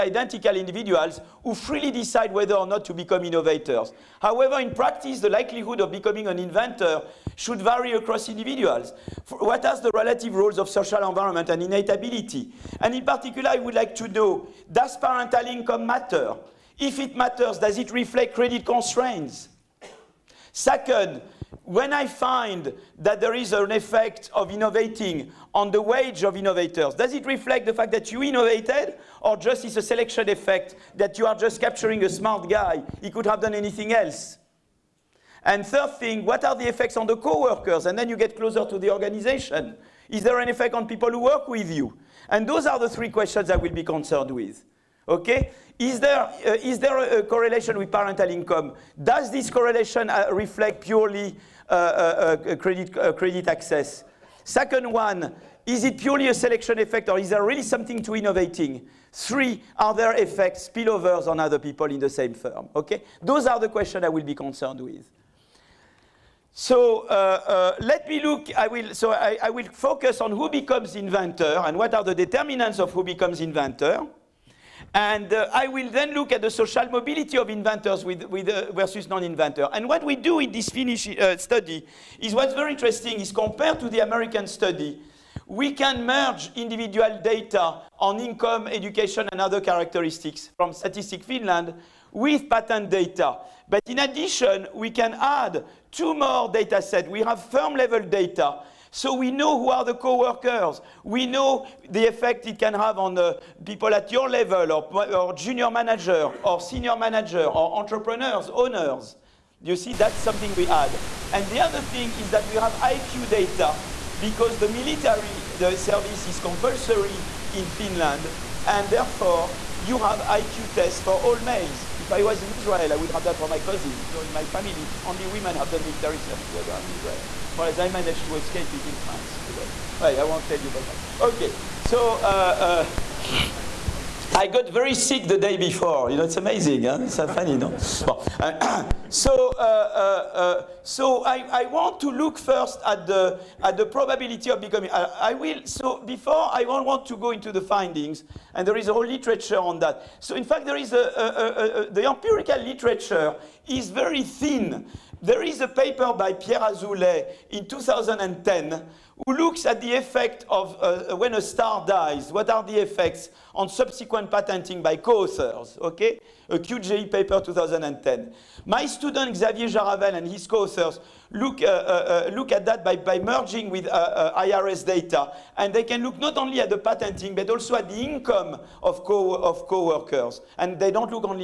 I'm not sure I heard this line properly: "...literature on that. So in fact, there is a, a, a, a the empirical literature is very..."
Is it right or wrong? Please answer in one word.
right.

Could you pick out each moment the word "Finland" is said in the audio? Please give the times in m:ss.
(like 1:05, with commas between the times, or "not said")
1:31, 1:57.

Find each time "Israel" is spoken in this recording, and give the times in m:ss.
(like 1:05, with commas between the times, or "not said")
2:02, 2:06.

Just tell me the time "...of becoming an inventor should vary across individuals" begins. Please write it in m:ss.
0:05.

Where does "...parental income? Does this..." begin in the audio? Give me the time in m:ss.
0:47.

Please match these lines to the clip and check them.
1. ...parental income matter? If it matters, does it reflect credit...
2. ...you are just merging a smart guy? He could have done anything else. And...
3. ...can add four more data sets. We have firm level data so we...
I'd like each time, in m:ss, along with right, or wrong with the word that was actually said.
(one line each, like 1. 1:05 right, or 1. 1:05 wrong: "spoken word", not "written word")
1. 0:14 right
2. 0:31 wrong: "capturing", not "merging"
3. 1:34 wrong: "two", not "four".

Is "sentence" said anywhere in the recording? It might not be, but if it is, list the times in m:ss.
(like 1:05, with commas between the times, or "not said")
not said.